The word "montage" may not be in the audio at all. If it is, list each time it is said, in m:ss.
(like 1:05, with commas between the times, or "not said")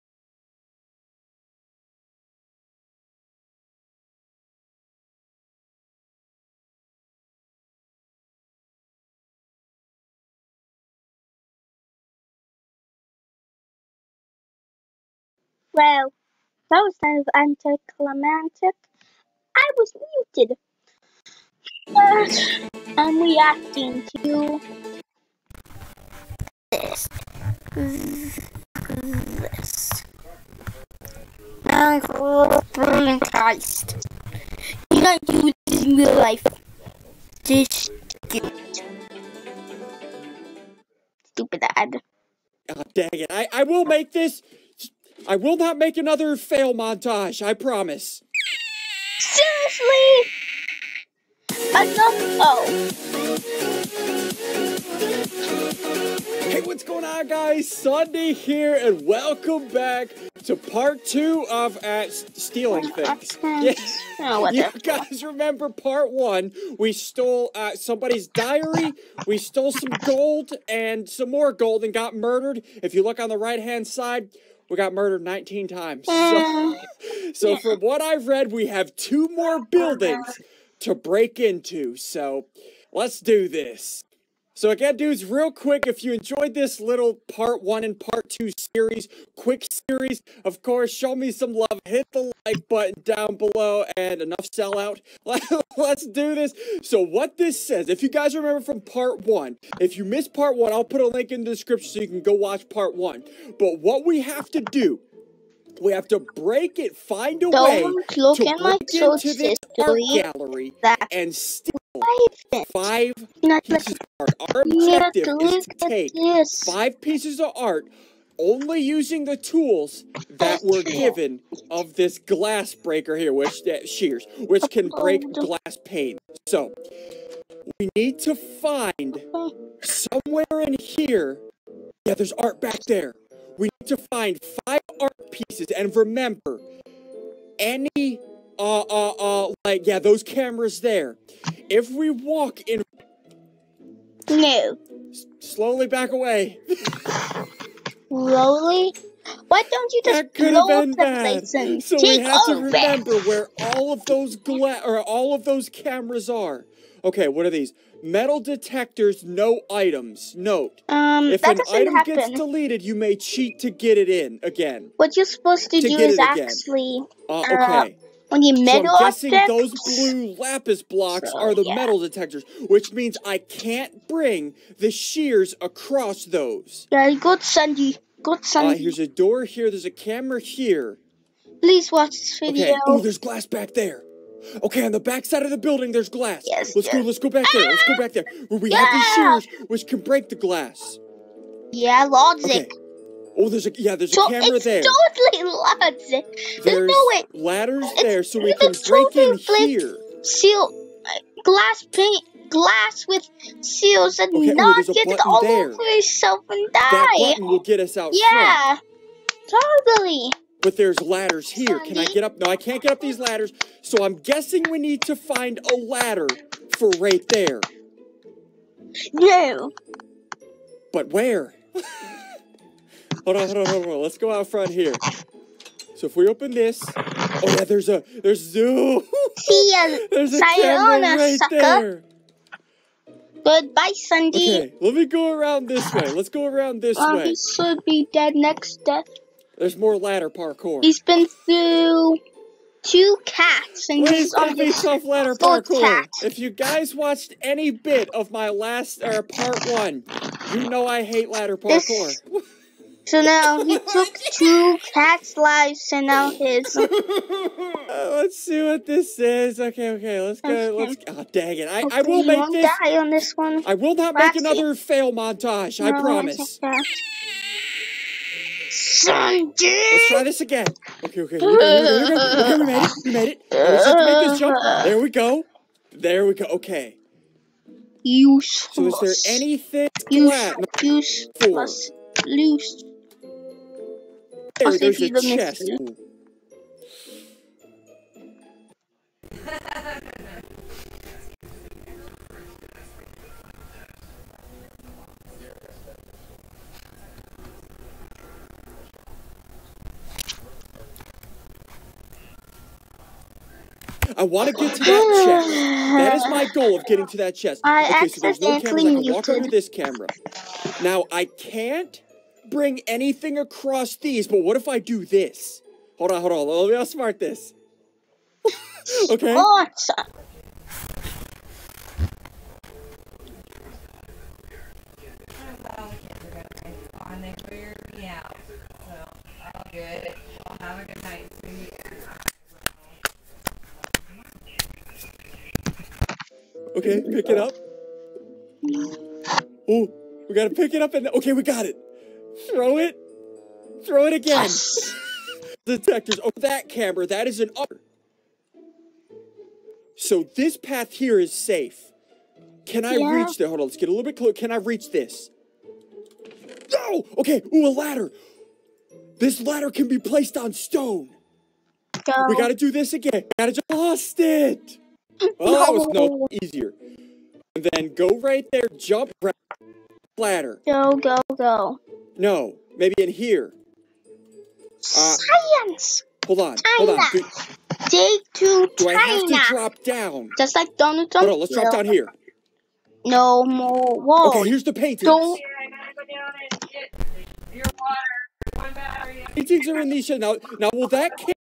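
0:46, 4:25.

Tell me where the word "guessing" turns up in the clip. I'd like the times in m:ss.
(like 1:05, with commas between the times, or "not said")
2:49, 3:34.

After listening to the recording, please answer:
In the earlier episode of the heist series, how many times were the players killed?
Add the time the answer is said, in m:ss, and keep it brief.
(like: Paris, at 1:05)
19, at 1:15.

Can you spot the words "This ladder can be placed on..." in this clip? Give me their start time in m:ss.
5:59.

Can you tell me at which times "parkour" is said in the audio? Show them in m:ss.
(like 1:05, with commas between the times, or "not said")
4:00, 4:05, 4:11.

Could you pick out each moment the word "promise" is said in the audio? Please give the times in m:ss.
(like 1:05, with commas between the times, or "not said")
0:47, 4:25.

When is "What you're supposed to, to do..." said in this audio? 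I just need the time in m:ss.
2:44.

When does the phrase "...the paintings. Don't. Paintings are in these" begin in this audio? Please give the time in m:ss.
6:24.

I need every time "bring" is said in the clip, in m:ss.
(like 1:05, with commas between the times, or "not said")
2:54, 5:12.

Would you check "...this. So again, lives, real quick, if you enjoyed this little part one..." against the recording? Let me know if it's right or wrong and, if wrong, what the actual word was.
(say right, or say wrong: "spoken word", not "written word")
wrong: "dudes", not "lives".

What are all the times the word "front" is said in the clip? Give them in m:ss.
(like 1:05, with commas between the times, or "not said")
3:28, 3:44.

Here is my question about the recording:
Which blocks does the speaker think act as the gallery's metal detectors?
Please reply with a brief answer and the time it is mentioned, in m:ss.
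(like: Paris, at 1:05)
Lapis blocks, at 2:50.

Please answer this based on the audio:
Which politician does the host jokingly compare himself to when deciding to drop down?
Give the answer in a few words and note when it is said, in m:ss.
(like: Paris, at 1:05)
Donald Trump, at 6:20.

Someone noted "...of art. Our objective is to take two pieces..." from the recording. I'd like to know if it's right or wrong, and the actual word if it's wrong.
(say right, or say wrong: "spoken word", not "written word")
wrong: "five", not "two".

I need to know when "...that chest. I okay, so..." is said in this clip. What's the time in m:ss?
5:07.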